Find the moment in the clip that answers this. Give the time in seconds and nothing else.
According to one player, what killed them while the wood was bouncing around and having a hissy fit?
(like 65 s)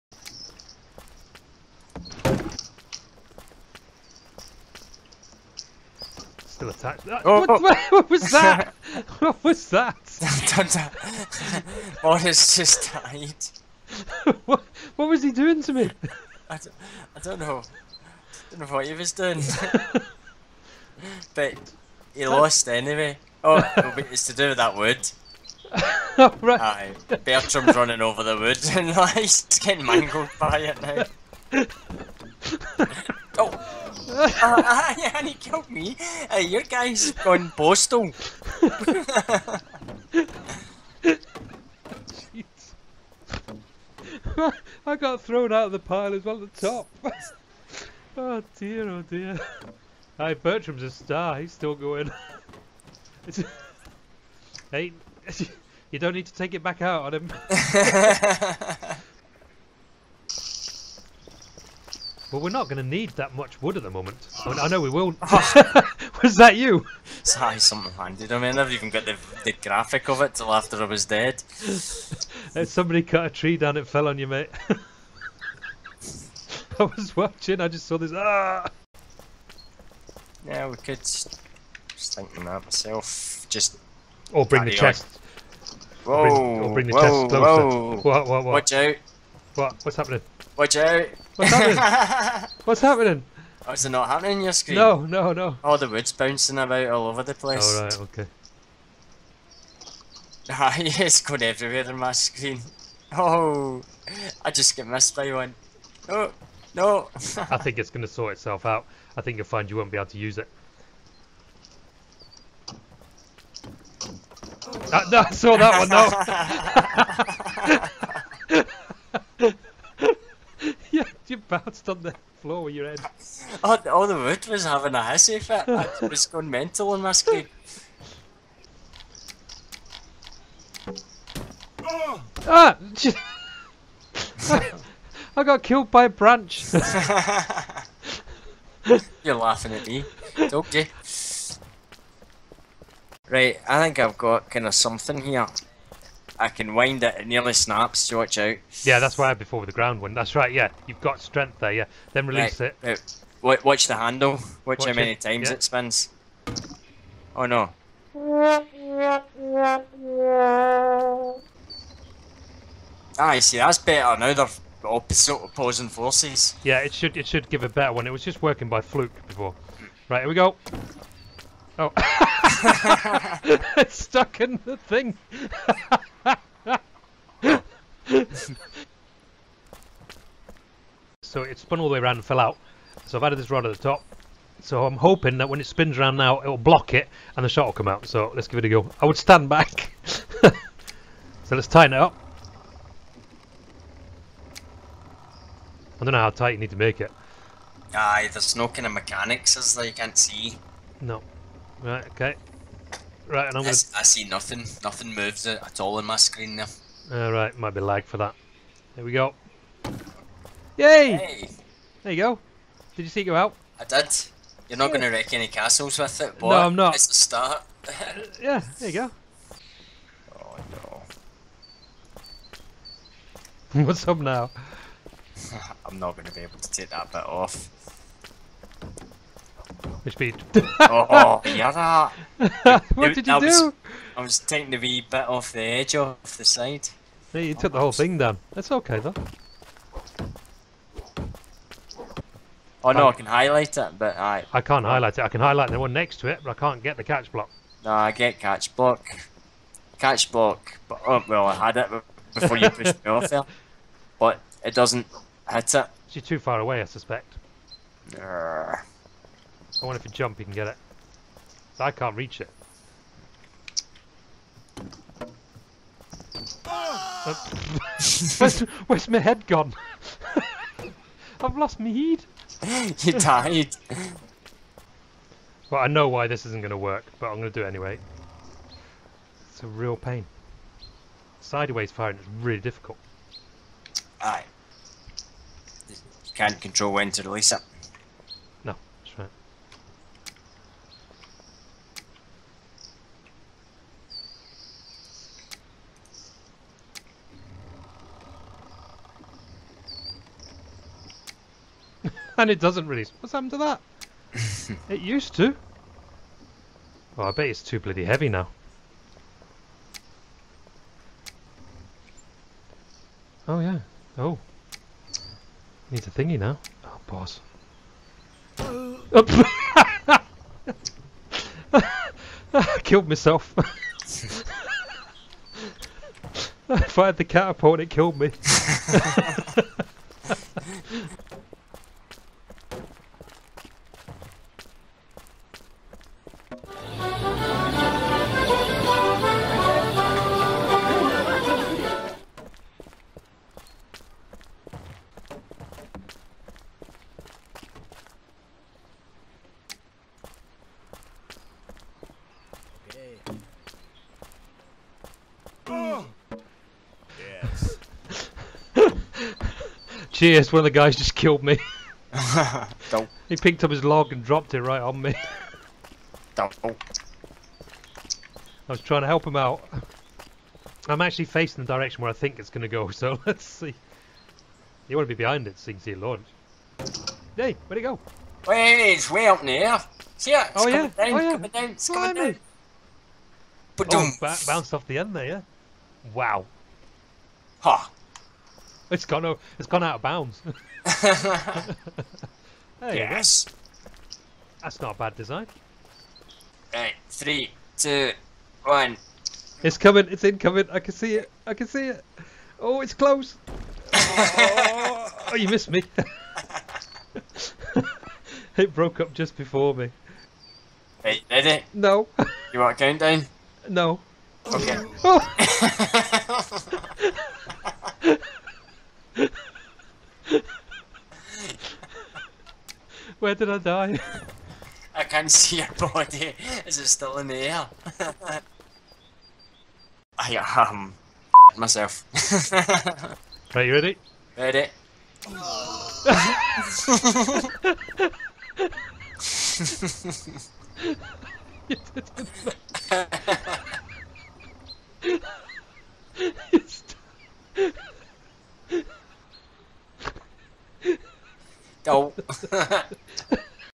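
135 s.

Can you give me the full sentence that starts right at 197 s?
Aye, there's no kind of mechanics as that you can't see.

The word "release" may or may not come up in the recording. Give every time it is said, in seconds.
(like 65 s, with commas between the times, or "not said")
152 s, 287 s, 302 s.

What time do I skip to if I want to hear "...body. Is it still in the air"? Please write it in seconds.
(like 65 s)
425 s.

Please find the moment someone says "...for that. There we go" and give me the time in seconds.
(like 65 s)
208 s.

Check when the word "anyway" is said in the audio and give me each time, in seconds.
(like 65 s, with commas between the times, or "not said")
22 s, 277 s.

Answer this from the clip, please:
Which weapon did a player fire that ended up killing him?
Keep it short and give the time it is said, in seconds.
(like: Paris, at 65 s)
catapult, at 327 s.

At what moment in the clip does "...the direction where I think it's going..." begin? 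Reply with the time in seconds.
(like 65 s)
371 s.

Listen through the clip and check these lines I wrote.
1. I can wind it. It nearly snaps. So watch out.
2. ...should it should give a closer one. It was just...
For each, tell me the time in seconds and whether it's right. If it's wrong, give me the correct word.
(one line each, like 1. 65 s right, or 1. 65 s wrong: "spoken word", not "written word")
1. 146 s right
2. 166 s wrong: "better", not "closer".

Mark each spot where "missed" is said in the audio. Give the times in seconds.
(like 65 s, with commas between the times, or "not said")
104 s, 405 s.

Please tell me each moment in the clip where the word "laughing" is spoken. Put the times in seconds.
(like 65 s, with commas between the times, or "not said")
139 s.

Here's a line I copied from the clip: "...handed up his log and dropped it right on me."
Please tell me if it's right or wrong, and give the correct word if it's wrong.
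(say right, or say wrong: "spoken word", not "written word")
wrong: "picked", not "handed".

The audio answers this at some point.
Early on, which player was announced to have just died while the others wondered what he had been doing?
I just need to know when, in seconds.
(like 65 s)
12 s.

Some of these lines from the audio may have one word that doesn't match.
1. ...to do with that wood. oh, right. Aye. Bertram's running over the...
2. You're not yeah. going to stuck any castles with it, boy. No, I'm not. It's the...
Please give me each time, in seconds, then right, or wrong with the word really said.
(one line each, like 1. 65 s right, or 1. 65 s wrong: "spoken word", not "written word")
1. 24 s right
2. 214 s wrong: "wreck", not "stuck".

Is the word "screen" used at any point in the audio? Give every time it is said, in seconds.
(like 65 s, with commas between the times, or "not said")
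94 s, 102 s, 206 s.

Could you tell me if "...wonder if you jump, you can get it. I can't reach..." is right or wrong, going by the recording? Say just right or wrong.
right.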